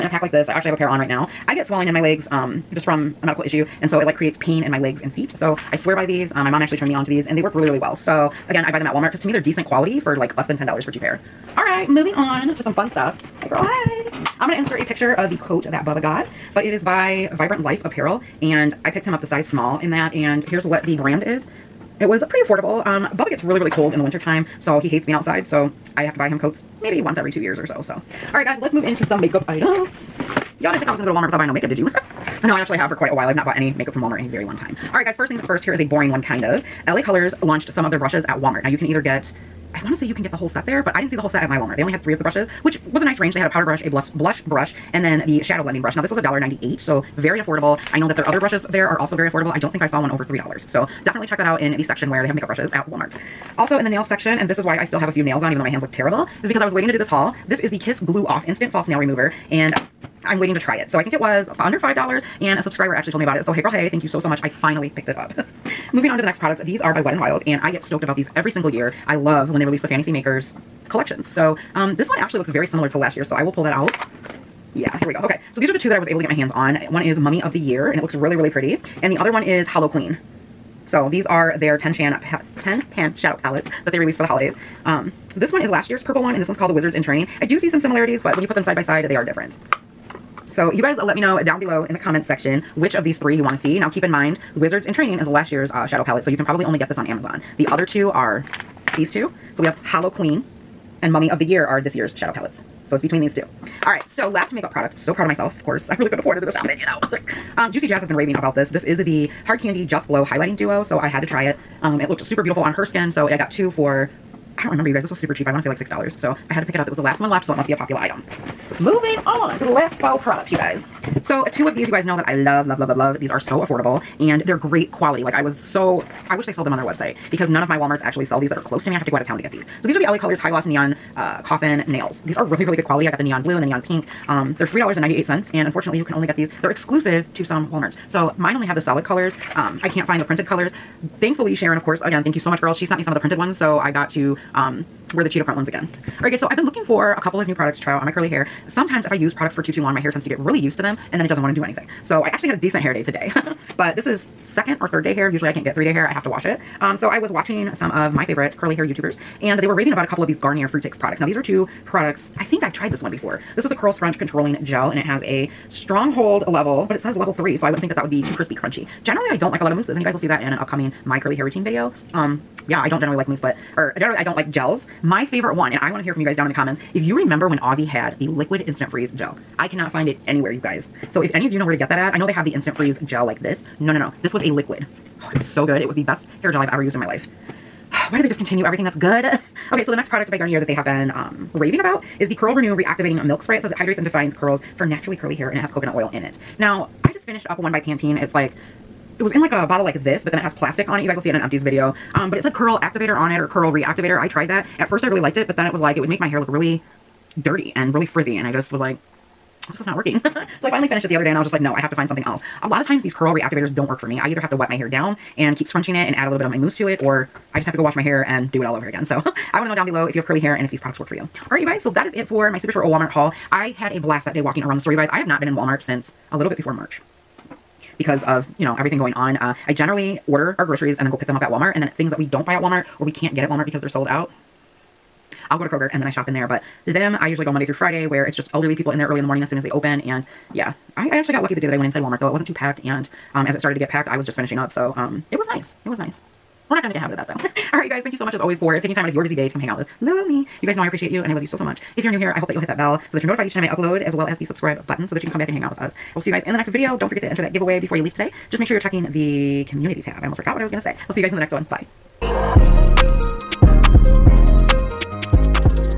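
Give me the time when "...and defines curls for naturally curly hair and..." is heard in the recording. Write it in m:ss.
3:13.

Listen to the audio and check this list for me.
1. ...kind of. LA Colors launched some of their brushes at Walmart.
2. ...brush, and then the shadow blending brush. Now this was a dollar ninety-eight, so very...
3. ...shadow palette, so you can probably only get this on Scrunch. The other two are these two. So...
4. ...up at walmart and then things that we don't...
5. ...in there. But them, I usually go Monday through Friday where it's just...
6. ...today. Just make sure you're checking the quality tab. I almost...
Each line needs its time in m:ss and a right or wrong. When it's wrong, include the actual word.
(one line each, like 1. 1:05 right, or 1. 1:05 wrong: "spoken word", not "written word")
1. 0:36 right
2. 0:44 right
3. 1:35 wrong: "Amazon", not "Scrunch"
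4. 3:51 right
5. 3:56 right
6. 4:18 wrong: "community", not "quality".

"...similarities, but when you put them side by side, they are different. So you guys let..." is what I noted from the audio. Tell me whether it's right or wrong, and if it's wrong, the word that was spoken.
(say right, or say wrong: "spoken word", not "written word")
right.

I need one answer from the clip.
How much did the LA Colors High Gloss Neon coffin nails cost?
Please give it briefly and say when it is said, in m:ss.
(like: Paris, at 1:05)
$3.98, at 2:14.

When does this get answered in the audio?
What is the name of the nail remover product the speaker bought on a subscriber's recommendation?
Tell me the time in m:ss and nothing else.
0:57.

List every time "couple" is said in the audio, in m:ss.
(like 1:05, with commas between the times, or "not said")
2:27, 2:40.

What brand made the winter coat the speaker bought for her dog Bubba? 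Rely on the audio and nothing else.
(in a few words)
Vibrant Life Apparel.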